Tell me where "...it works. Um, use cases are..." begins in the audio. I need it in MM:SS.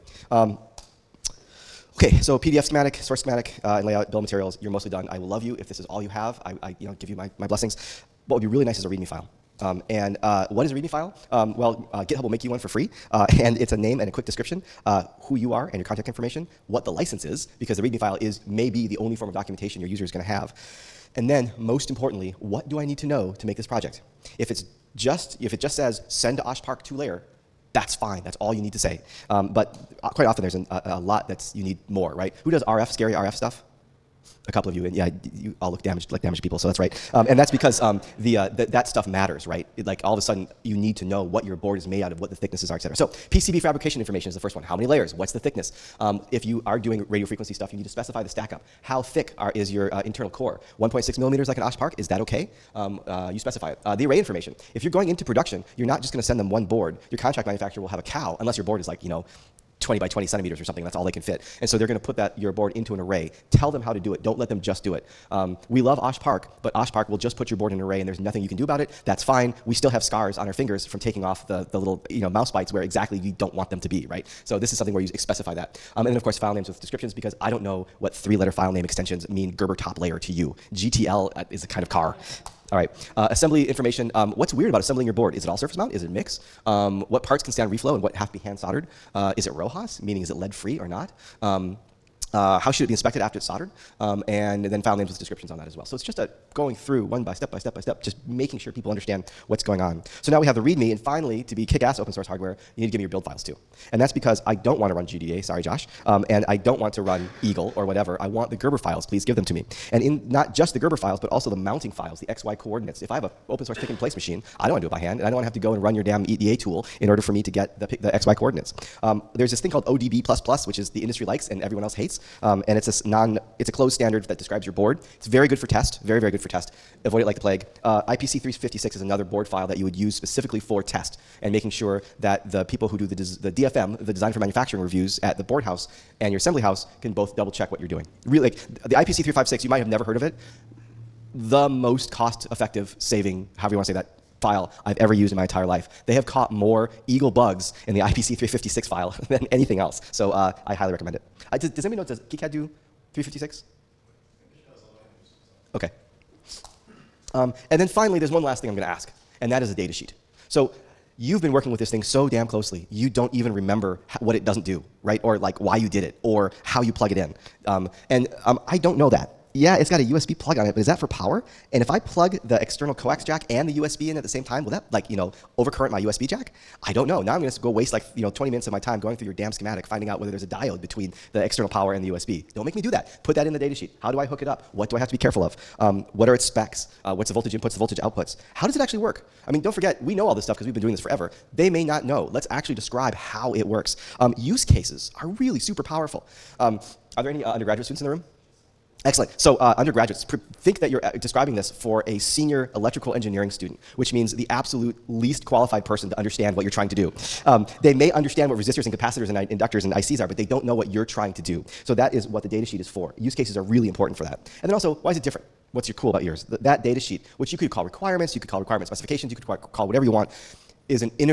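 03:13.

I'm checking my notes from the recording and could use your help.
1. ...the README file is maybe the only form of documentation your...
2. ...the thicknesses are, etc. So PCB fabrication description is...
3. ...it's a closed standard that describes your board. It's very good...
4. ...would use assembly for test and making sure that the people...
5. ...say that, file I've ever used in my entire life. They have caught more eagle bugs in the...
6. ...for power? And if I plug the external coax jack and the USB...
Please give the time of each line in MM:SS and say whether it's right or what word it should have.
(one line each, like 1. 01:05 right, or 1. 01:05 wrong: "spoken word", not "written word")
1. 00:17 right
2. 00:42 wrong: "information", not "description"
3. 02:03 right
4. 02:09 wrong: "specifically", not "assembly"
5. 02:23 right
6. 02:50 right.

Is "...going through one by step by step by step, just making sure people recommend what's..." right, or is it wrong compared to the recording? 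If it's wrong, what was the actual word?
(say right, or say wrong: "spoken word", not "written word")
wrong: "understand", not "recommend".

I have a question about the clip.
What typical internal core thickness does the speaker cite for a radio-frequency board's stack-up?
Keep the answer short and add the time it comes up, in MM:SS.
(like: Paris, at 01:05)
1.6 millimeters, at 00:50.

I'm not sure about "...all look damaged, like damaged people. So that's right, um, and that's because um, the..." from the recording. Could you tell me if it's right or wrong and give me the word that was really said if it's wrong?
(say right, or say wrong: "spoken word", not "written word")
right.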